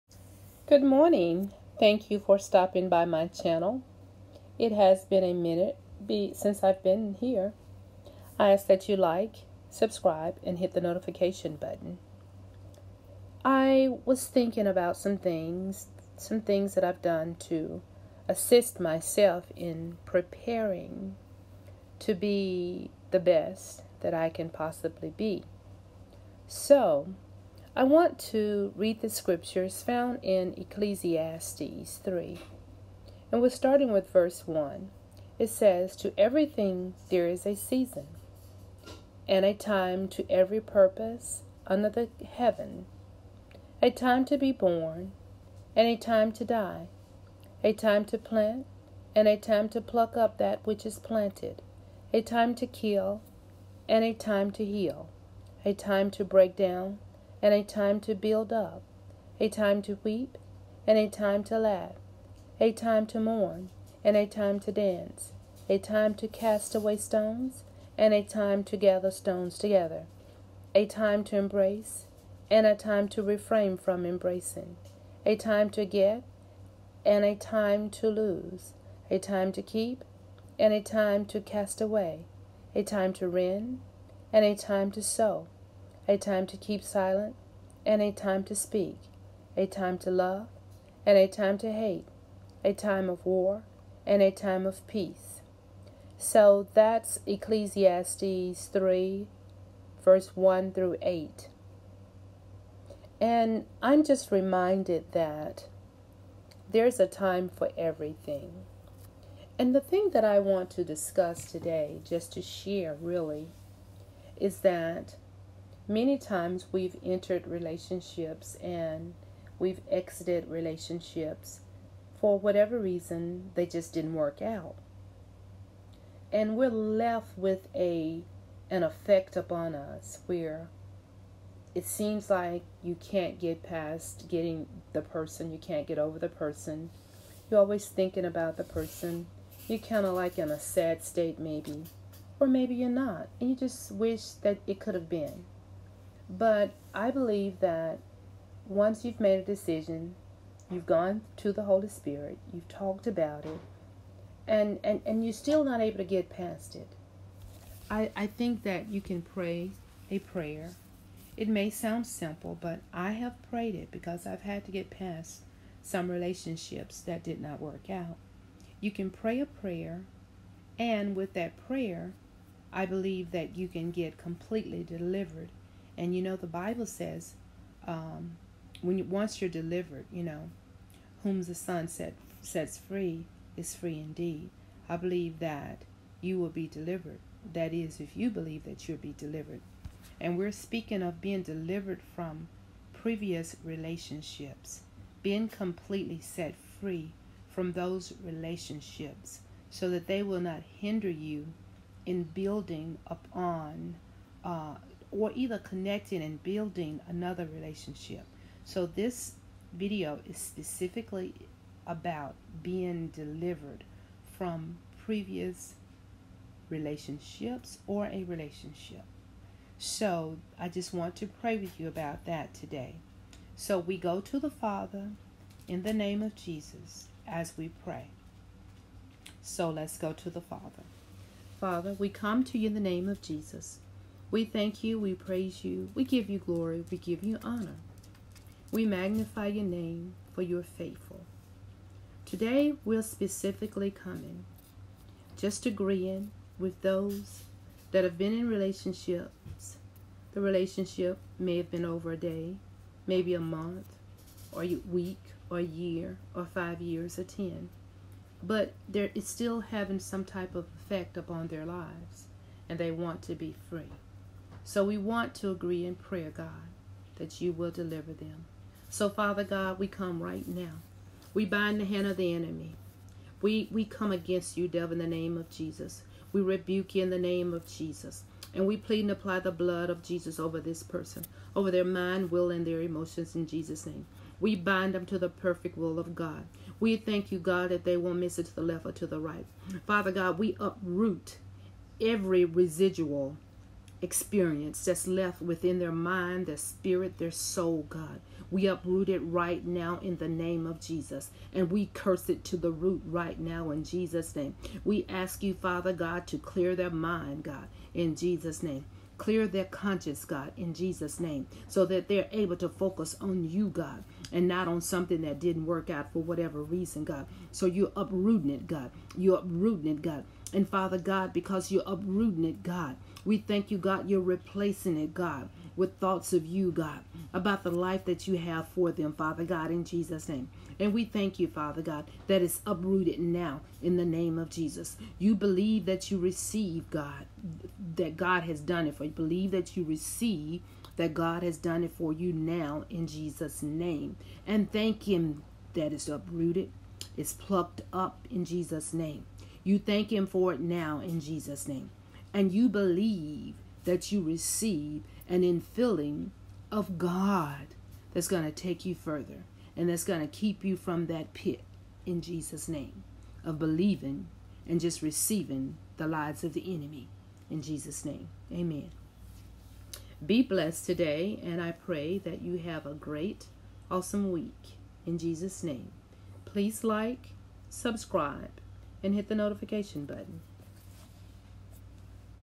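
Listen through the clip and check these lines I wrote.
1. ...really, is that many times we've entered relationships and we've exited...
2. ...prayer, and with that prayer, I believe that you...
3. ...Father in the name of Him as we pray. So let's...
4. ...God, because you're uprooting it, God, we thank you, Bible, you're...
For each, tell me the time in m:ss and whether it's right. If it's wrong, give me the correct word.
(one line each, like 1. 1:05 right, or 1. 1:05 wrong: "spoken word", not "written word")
1. 1:52 right
2. 2:49 right
3. 3:44 wrong: "Jesus", not "Him"
4. 5:20 wrong: "God", not "Bible".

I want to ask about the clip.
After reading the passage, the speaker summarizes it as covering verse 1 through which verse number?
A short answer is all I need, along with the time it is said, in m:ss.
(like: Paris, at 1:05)
8, at 1:41.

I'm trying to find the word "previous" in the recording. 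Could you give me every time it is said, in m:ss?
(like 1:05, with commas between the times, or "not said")
3:12, 3:35.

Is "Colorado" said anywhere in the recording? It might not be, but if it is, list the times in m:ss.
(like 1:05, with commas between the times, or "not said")
not said.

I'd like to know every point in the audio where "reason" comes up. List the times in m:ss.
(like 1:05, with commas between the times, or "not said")
2:02, 5:16.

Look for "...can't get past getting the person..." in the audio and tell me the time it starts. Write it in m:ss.
2:12.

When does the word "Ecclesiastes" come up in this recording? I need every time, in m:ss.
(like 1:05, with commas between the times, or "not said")
0:30, 1:37.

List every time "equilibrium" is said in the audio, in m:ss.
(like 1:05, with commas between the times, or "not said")
not said.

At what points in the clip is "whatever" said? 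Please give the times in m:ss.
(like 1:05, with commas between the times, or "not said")
2:02, 5:16.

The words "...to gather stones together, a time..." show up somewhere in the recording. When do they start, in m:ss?
1:08.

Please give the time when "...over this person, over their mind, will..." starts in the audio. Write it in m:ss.
4:40.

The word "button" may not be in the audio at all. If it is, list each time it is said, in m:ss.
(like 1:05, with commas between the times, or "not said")
0:11, 6:20.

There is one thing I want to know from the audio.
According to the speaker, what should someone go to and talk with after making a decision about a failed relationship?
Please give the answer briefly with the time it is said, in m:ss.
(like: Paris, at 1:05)
The Holy Spirit, at 2:31.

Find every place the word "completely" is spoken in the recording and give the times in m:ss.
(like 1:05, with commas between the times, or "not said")
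2:54, 3:15.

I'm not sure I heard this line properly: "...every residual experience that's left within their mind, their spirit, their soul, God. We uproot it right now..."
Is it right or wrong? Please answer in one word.
right.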